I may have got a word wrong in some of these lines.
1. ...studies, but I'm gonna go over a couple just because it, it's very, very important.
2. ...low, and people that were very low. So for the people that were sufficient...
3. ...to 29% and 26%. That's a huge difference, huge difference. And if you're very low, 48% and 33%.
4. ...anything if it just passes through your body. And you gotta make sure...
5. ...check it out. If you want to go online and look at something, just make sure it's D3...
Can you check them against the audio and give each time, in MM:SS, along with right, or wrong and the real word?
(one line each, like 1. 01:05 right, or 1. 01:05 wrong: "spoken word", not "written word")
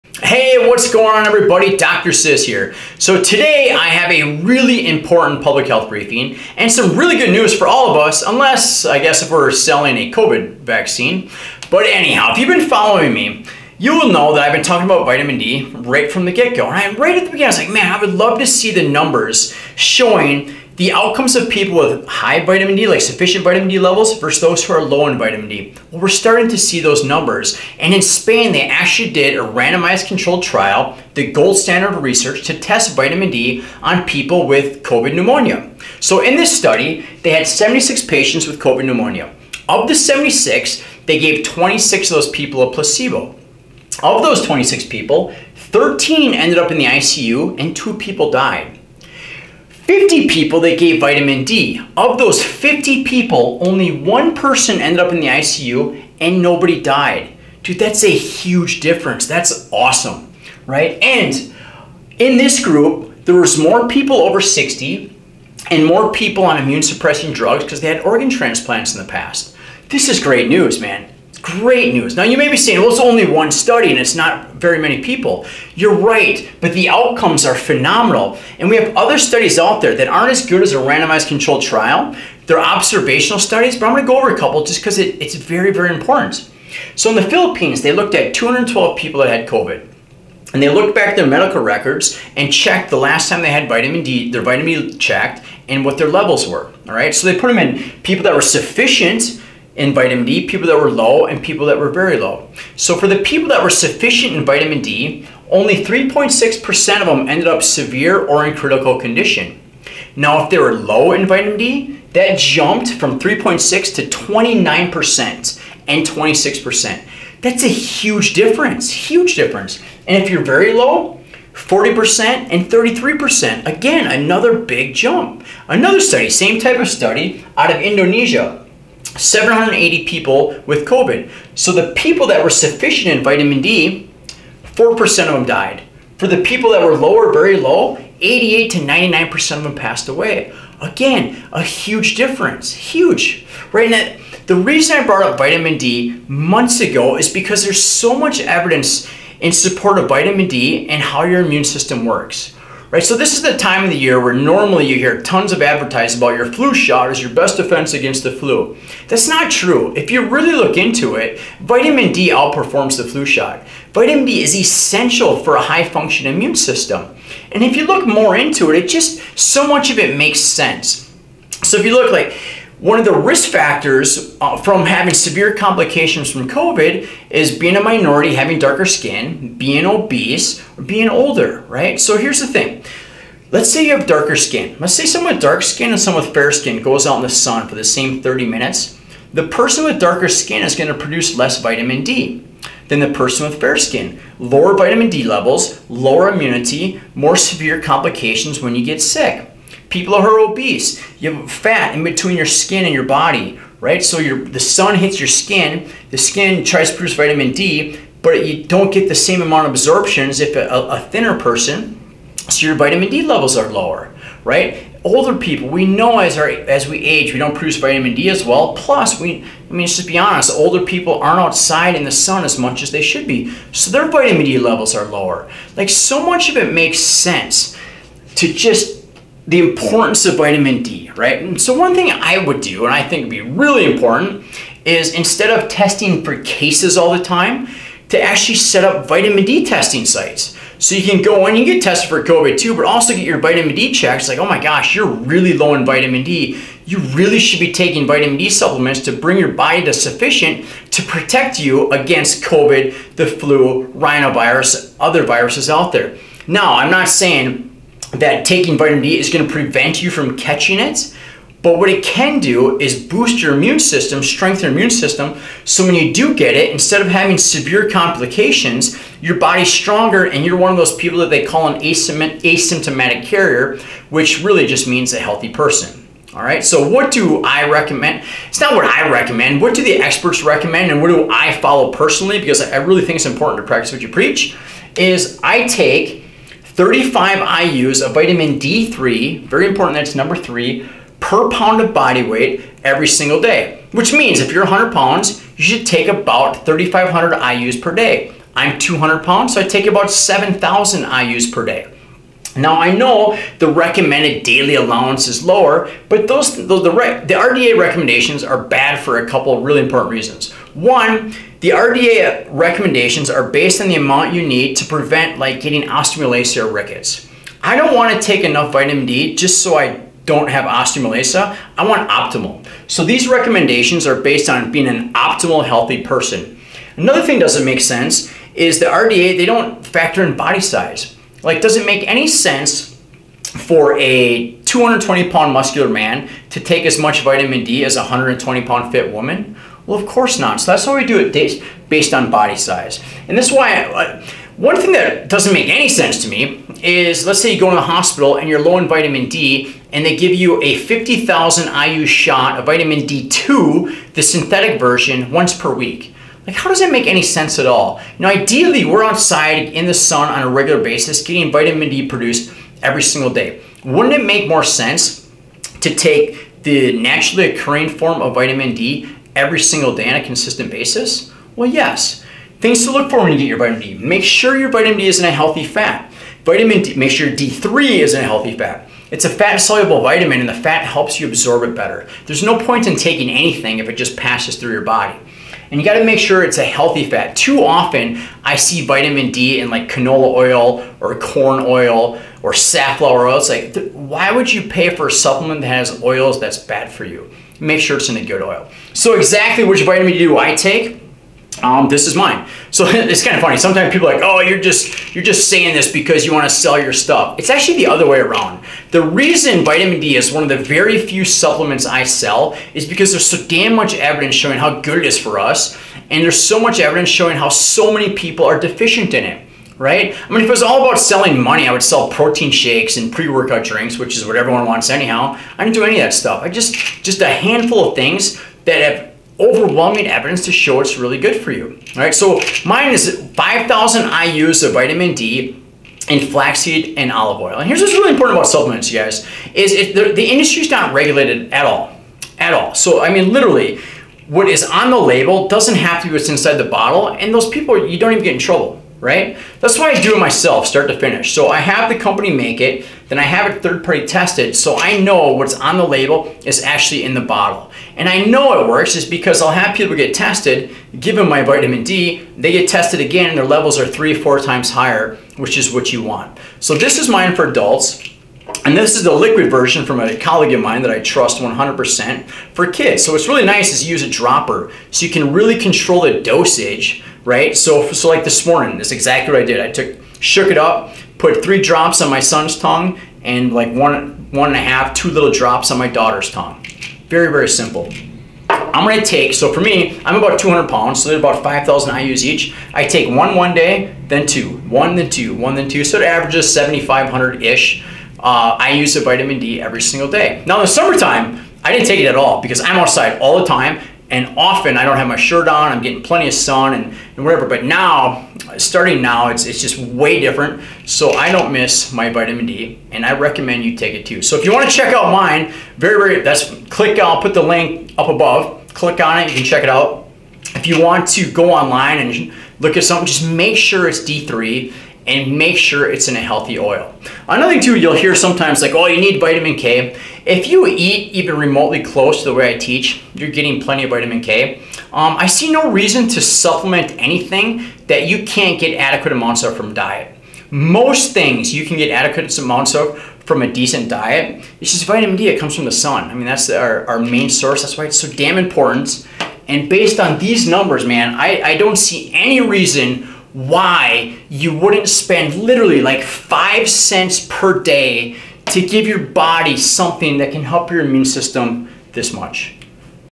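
1. 01:23 right
2. 01:40 right
3. 01:53 wrong: "40", not "48"
4. 06:23 right
5. 08:39 right.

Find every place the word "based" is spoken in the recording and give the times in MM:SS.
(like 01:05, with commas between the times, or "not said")
05:13, 05:24, 05:41, 09:09.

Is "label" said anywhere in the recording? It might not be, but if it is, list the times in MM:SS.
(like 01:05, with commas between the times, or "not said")
07:24, 07:35.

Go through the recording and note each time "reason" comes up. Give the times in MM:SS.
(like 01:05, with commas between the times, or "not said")
02:24, 05:10, 06:49, 08:55, 09:12.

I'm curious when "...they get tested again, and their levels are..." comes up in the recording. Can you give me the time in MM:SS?
07:42.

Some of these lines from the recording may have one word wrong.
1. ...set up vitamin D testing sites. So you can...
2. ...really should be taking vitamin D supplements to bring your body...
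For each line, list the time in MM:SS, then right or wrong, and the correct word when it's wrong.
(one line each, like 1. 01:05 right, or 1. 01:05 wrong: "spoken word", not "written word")
1. 03:58 right
2. 04:06 right.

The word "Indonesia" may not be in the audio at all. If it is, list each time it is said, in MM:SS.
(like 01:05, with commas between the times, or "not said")
02:07.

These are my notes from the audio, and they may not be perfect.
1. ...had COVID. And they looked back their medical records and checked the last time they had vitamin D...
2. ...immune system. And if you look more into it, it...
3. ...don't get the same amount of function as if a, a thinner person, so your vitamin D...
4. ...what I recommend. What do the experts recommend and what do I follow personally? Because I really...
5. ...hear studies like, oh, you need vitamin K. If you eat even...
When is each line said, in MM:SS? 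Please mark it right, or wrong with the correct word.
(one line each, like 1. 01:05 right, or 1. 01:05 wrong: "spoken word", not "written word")
1. 01:29 right
2. 02:46 right
3. 03:28 wrong: "absorption", not "function"
4. 04:38 right
5. 08:47 wrong: "sometimes", not "studies".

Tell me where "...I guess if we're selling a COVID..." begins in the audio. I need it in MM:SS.
00:08.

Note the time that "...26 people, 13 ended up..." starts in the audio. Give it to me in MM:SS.
00:44.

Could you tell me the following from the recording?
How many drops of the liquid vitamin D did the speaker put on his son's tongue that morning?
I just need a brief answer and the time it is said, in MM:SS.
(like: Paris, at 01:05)
3, at 08:01.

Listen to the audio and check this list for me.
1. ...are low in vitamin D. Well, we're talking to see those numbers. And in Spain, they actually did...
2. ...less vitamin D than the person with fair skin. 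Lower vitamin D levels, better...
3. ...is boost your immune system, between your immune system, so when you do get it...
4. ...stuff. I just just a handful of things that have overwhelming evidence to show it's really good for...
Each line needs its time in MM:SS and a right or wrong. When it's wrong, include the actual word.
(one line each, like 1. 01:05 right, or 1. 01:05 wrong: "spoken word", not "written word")
1. 00:24 wrong: "starting", not "talking"
2. 03:11 wrong: "lower", not "better"
3. 04:22 wrong: "strengthen", not "between"
4. 07:06 right.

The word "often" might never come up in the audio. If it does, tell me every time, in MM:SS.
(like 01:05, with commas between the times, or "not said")
06:27, 08:24.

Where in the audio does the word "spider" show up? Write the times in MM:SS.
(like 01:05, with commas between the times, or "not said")
not said.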